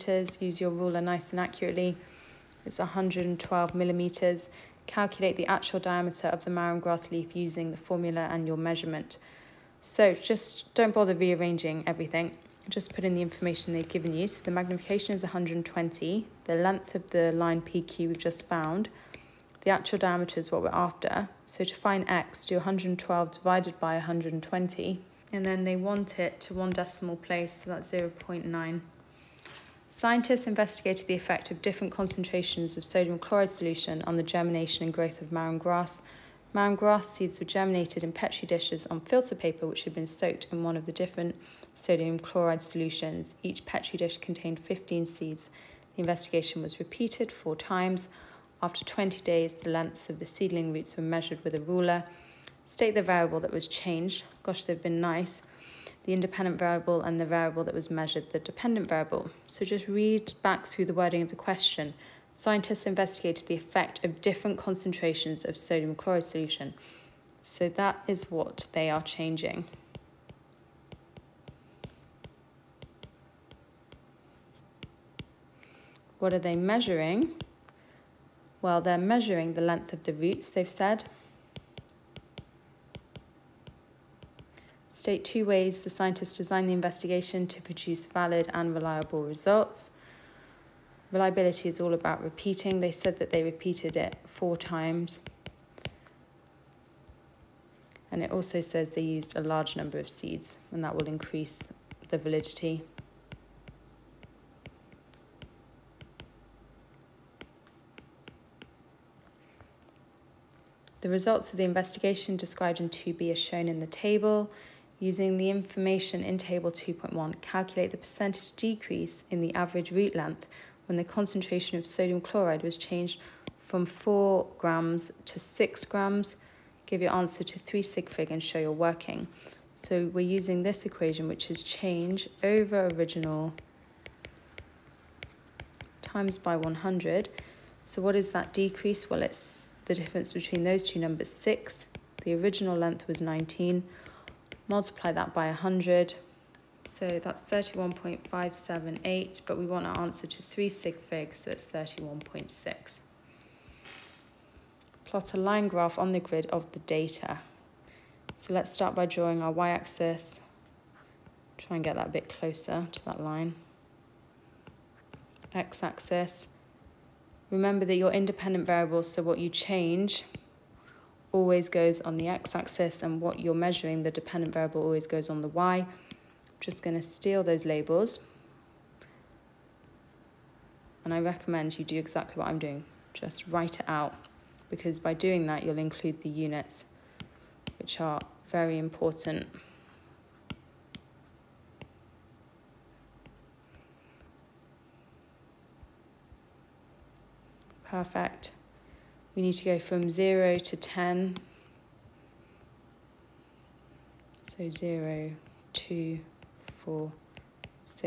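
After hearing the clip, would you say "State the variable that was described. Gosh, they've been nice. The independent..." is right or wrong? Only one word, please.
wrong.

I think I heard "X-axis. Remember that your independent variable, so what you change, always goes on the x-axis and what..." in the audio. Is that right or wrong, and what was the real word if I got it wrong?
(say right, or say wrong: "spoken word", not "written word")
right.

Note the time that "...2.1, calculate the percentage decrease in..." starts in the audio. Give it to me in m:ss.
1:56.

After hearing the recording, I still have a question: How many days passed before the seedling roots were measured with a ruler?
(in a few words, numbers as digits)
20.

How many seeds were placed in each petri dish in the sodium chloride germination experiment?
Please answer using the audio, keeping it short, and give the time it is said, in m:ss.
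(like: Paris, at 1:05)
15, at 0:44.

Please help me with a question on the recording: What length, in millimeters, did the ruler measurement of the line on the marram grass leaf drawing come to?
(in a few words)
112 millimeters.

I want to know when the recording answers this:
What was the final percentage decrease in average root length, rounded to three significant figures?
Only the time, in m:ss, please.
2:31.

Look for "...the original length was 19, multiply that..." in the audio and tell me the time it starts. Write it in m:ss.
2:22.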